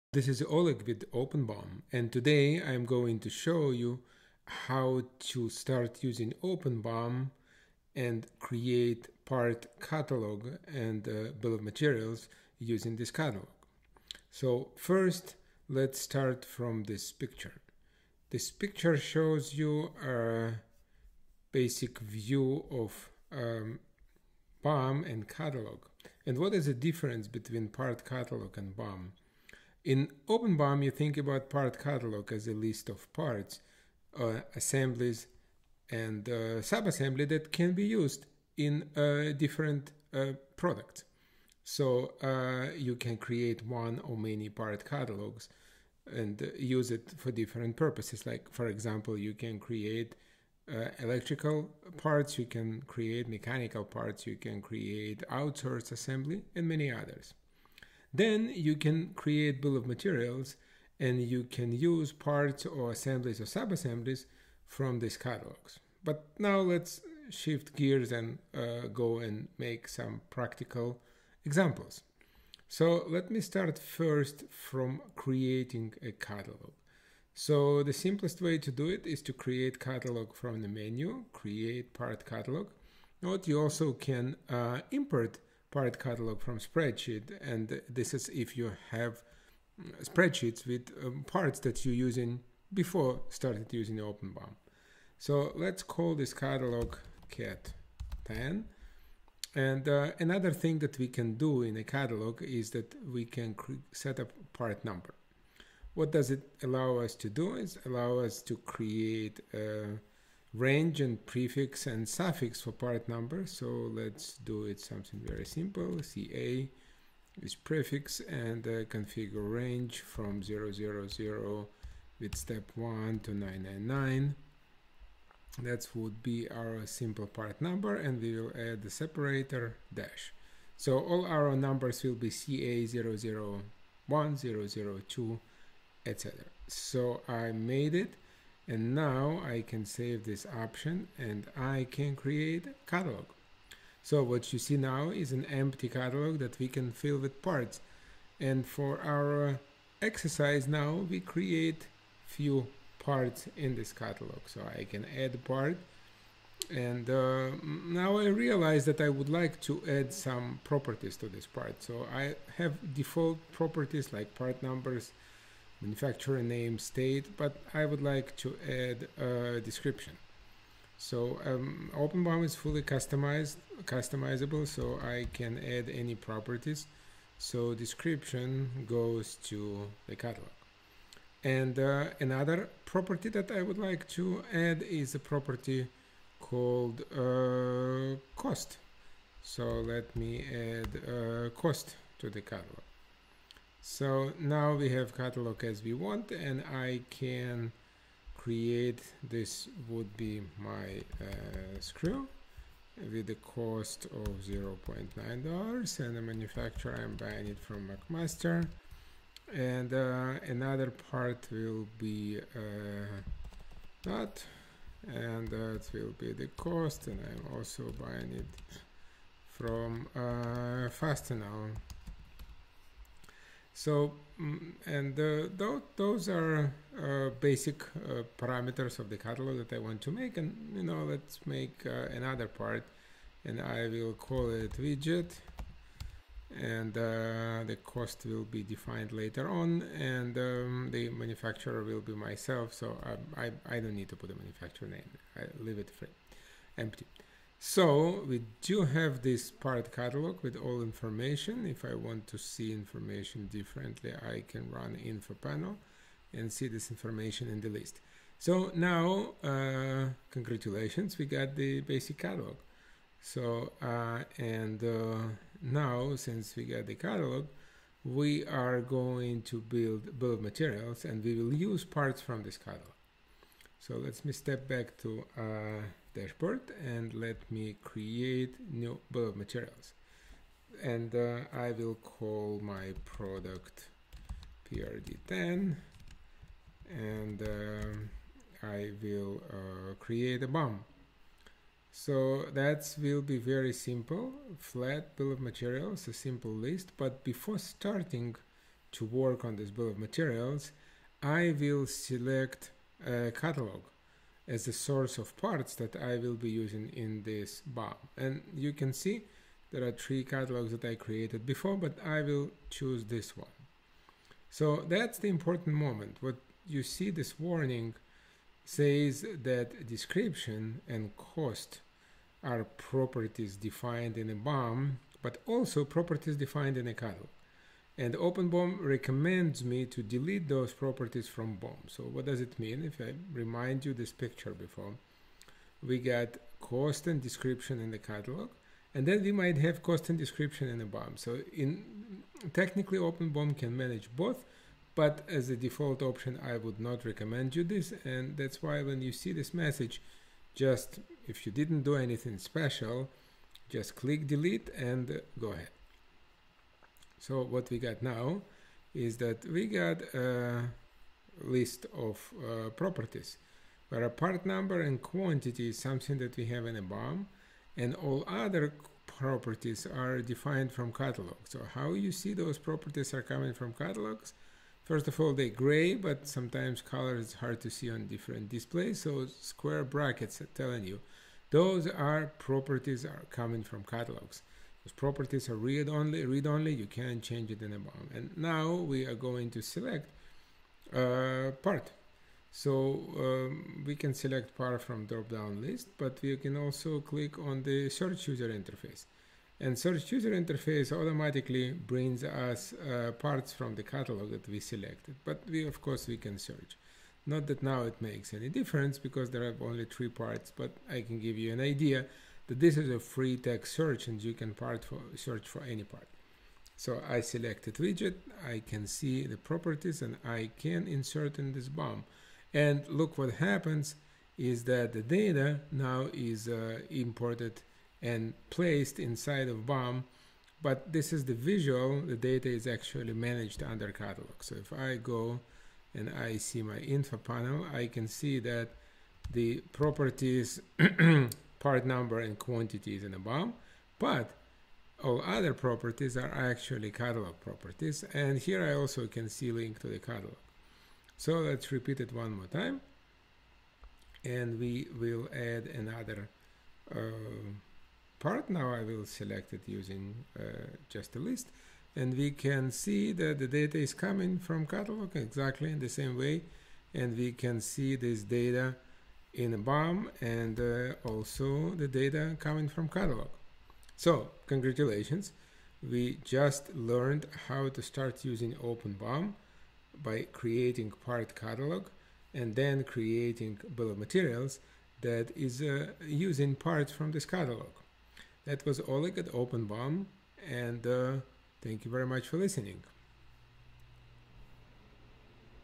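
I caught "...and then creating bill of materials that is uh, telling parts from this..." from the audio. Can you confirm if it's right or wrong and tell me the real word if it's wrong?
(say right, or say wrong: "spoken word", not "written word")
wrong: "using", not "telling".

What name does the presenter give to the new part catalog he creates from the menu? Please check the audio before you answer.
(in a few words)
cat 10.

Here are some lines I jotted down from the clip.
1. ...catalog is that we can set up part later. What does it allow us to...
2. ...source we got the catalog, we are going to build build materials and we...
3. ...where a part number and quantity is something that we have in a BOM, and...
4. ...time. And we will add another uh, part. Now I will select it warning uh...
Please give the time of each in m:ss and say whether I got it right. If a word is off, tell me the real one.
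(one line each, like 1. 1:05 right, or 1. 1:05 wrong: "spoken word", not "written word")
1. 1:41 wrong: "number", not "later"
2. 4:26 wrong: "since", not "source"
3. 6:03 right
4. 7:32 wrong: "using", not "warning".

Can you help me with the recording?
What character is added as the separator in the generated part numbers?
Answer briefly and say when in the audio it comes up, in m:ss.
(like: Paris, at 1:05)
dash, at 2:09.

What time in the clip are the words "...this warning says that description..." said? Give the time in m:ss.
5:17.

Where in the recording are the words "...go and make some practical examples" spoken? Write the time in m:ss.
1:08.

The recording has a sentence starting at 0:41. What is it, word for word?
So uh, you can create one or many part catalogs and use it for different purposes.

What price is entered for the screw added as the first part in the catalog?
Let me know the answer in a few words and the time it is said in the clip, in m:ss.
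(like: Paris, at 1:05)
$0.9, at 3:24.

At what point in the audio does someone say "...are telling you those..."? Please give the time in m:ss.
6:20.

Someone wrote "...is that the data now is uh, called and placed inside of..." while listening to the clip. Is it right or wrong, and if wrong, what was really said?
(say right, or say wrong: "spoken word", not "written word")
wrong: "imported", not "called".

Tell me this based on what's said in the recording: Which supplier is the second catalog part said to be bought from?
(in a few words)
Fastenal.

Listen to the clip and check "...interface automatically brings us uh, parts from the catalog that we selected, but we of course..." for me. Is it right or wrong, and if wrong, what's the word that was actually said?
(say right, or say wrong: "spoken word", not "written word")
right.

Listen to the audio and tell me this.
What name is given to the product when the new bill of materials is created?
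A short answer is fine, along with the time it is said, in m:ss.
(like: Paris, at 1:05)
prd10, at 4:44.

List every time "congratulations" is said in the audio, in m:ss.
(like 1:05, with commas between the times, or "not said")
4:20, 7:54.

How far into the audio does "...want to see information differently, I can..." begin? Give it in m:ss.
4:11.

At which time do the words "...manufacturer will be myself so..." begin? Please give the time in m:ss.
4:01.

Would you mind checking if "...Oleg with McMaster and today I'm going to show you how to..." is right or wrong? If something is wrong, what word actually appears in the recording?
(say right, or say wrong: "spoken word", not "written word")
wrong: "OpenBOM", not "McMaster".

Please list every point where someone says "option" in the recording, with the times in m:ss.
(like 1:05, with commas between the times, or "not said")
2:20, 5:46.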